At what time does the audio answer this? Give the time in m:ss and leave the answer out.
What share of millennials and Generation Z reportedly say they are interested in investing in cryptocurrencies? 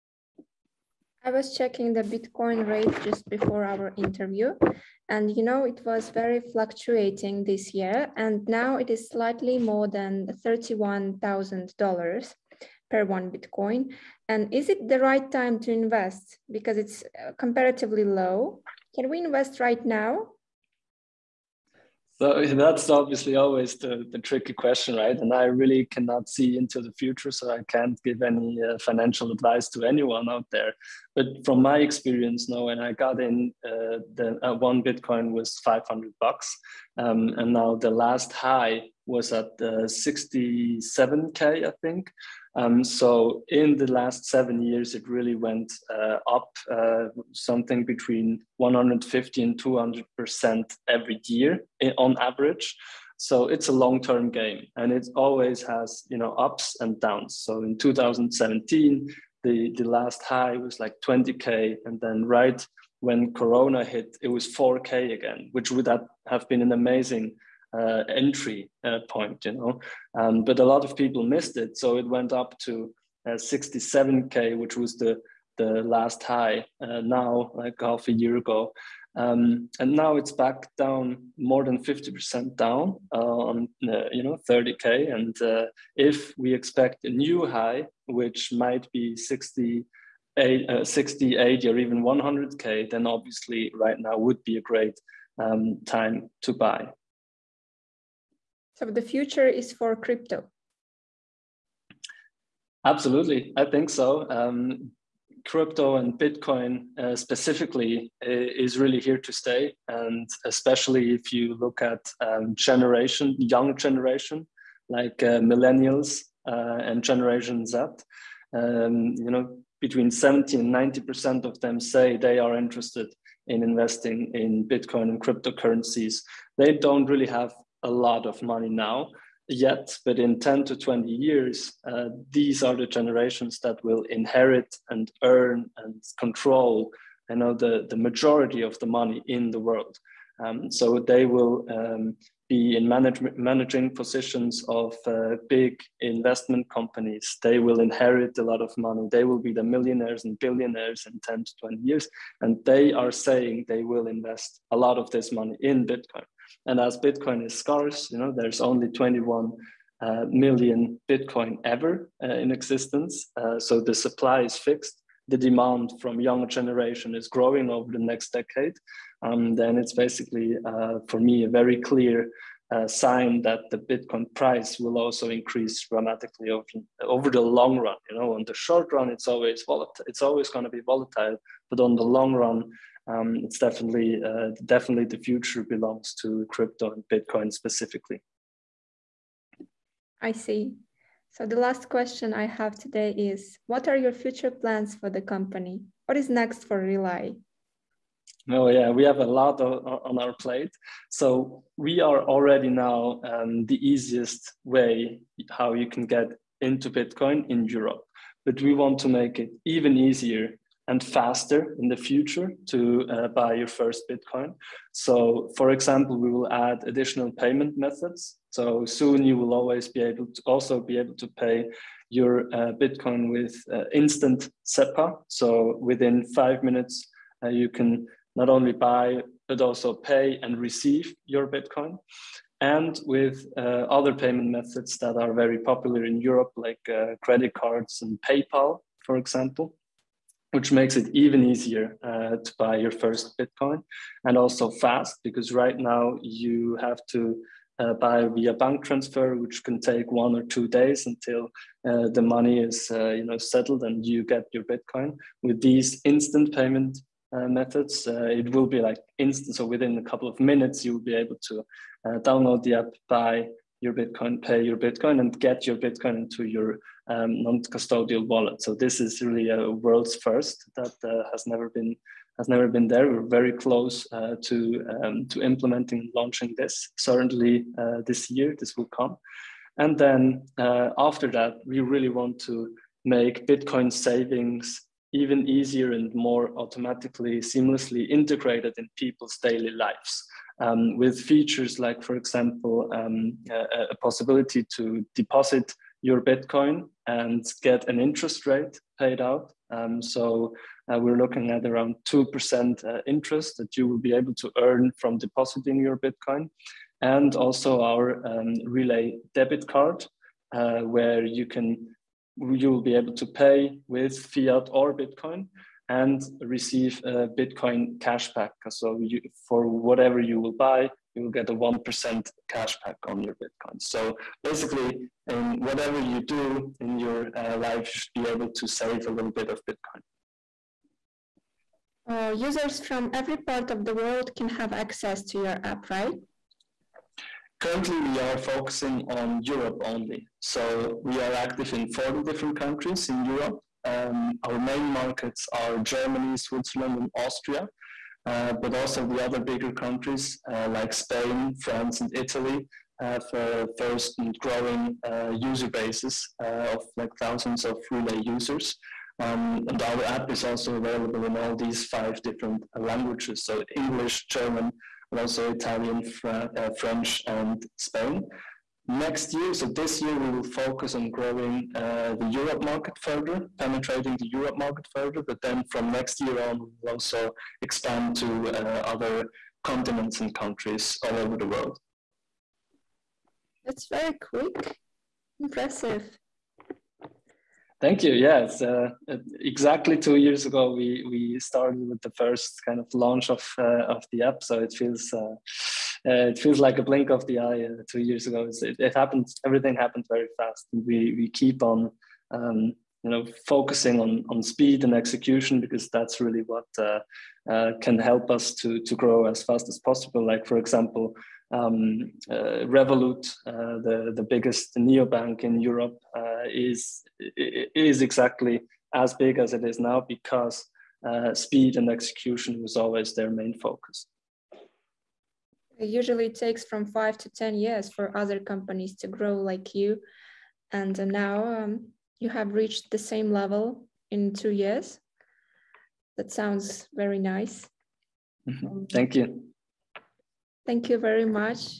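1:59.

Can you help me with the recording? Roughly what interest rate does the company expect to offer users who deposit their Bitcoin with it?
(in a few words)
2%.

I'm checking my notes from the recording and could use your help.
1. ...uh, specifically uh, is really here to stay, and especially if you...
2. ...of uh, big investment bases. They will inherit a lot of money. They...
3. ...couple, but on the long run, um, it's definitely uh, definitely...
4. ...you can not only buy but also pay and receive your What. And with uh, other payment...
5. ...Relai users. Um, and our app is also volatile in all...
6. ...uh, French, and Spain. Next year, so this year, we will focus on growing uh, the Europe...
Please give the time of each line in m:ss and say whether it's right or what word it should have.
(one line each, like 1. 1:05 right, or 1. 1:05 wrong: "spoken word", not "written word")
1. 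1:46 right
2. 2:24 wrong: "companies", not "bases"
3. 3:00 wrong: "volatile", not "couple"
4. 3:47 wrong: "Bitcoin", not "What"
5. 5:57 wrong: "available", not "volatile"
6. 6:06 right.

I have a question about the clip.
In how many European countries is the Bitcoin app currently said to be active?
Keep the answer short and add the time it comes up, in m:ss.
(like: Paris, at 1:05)
40, at 5:41.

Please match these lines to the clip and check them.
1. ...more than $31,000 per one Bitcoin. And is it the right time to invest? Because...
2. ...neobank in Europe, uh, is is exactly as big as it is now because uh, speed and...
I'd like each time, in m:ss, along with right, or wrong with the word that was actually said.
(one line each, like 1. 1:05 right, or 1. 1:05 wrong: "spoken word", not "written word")
1. 0:09 right
2. 6:54 right.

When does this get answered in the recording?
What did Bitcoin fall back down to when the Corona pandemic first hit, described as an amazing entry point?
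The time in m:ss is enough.
1:04.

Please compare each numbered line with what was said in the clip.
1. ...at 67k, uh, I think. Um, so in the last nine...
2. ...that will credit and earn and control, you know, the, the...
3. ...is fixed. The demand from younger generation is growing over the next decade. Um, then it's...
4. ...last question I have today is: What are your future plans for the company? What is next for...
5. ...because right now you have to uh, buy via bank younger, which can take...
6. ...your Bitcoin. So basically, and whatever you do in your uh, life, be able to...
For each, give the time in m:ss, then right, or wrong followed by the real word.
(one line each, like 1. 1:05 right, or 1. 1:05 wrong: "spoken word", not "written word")
1. 0:39 wrong: "seven", not "nine"
2. 2:13 wrong: "inherit", not "credit"
3. 2:44 right
4. 3:11 right
5. 4:05 wrong: "transfer", not "younger"
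6. 5:23 right.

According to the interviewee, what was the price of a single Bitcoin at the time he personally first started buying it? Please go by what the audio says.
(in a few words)
$500.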